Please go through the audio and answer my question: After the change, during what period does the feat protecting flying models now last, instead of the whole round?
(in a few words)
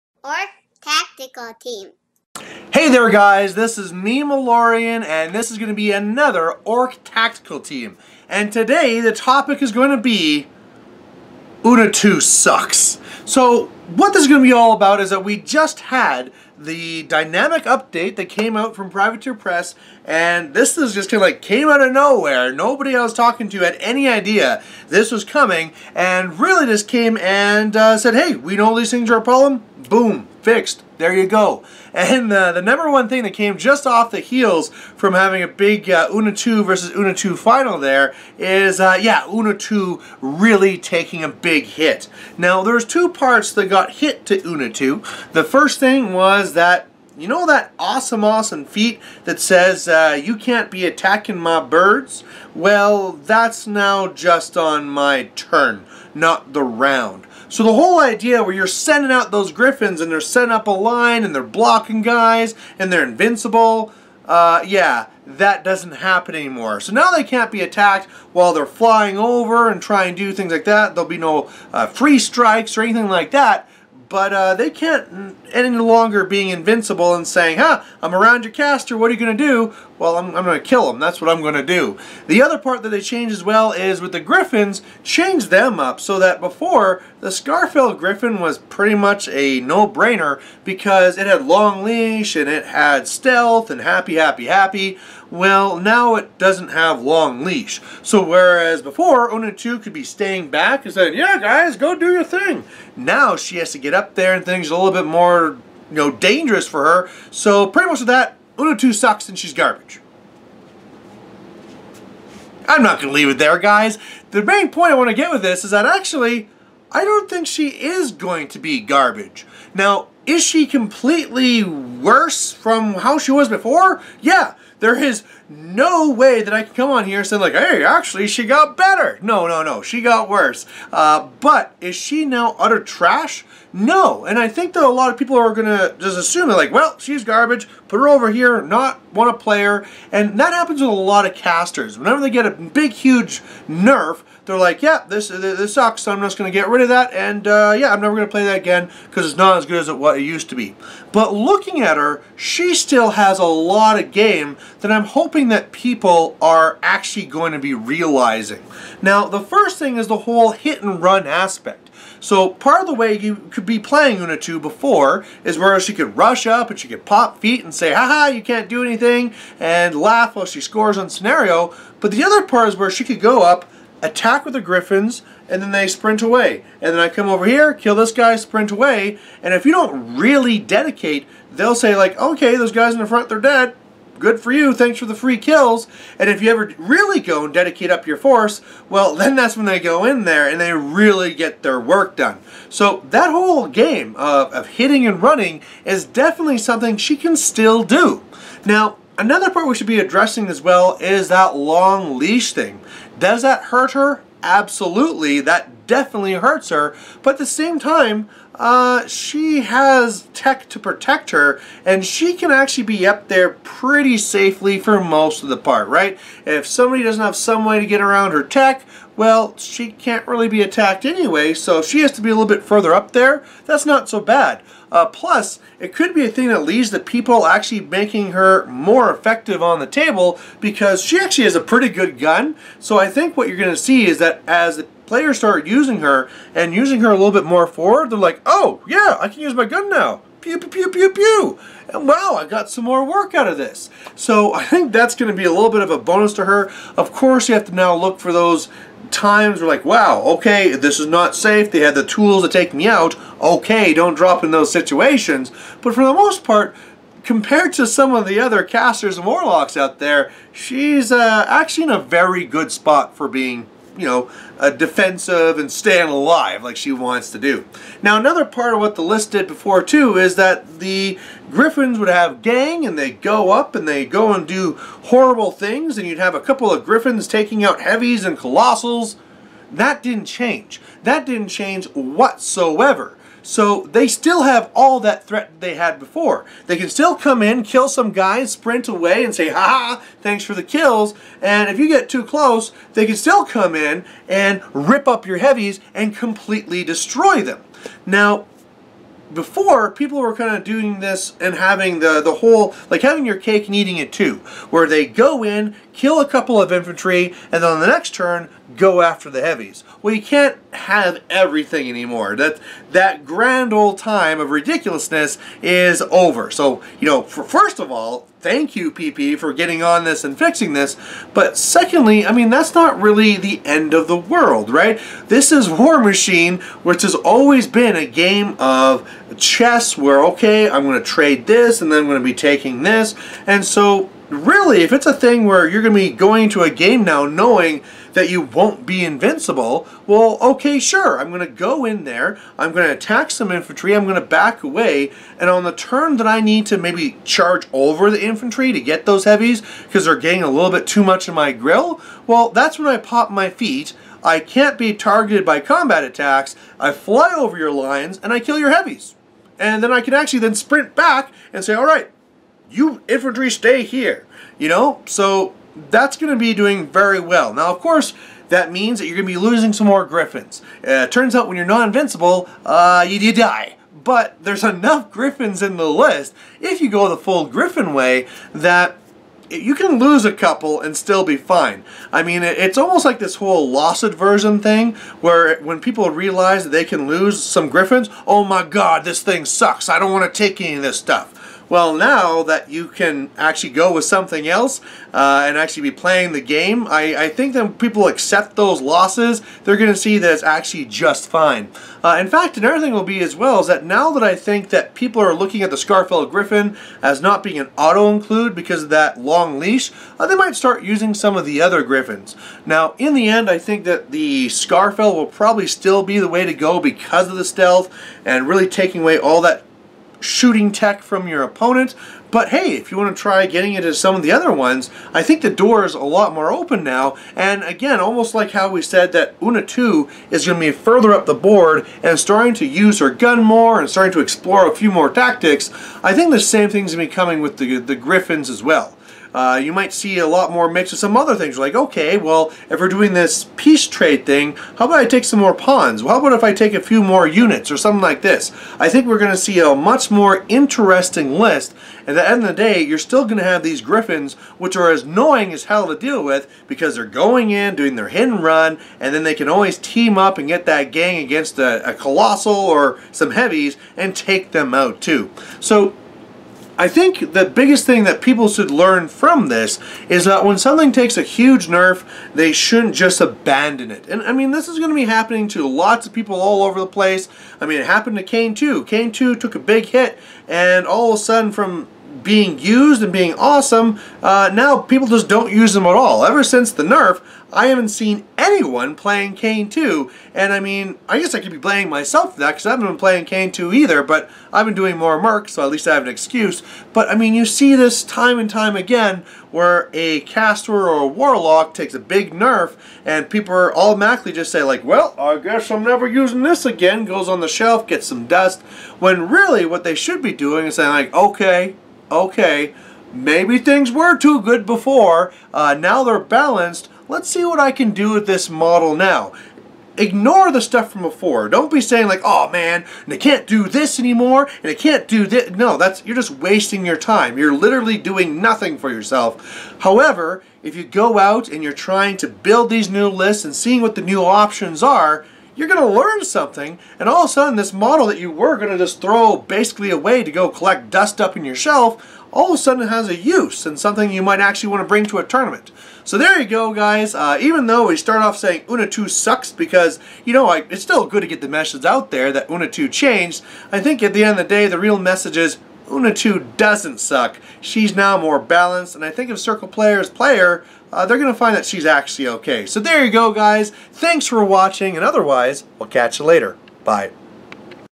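My turn.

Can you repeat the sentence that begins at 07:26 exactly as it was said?
Well, how about if I take a few more units or something like this?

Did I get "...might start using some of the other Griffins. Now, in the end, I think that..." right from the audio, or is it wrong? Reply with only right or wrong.
right.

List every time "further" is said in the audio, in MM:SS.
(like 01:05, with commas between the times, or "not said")
03:42, 07:10.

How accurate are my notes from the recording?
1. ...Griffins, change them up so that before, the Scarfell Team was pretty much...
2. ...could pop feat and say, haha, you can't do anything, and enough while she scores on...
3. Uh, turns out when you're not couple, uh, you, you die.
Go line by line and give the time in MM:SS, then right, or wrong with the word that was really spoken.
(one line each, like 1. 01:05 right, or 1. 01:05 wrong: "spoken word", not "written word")
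1. 01:24 wrong: "Griffin", not "Team"
2. 02:46 wrong: "laugh", not "enough"
3. 06:10 wrong: "invincible", not "couple".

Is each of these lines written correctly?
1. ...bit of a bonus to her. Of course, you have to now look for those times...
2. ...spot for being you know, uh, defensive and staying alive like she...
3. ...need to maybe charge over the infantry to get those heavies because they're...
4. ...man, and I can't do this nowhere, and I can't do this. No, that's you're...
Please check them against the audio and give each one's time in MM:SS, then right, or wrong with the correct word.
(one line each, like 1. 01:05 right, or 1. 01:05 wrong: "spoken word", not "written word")
1. 04:05 right
2. 04:22 right
3. 05:46 right
4. 08:42 wrong: "anymore", not "nowhere".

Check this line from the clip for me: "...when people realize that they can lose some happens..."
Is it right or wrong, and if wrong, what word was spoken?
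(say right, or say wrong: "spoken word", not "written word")
wrong: "griffins", not "happens".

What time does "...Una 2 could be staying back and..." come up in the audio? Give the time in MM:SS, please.
01:39.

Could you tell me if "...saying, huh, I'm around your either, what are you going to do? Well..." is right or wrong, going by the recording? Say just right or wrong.
wrong.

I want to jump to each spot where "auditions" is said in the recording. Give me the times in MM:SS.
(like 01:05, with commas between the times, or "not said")
not said.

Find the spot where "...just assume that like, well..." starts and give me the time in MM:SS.
02:15.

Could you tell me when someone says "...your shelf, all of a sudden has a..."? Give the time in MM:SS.
09:01.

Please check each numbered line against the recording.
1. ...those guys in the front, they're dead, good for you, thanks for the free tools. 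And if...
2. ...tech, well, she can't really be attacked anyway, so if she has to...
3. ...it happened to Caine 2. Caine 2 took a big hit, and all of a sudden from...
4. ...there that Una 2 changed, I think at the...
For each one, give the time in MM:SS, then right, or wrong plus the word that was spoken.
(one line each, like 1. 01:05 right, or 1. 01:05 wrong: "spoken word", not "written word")
1. 03:02 wrong: "kills", not "tools"
2. 03:38 right
3. 07:57 right
4. 09:12 right.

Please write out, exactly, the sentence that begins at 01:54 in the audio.
The main point I want to get with this is that actually, I don't think she is going to be garbage.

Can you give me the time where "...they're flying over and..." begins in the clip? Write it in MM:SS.
01:08.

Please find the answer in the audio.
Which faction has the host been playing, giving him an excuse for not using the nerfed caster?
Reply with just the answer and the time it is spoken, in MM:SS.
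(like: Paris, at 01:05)
Merc, at 08:15.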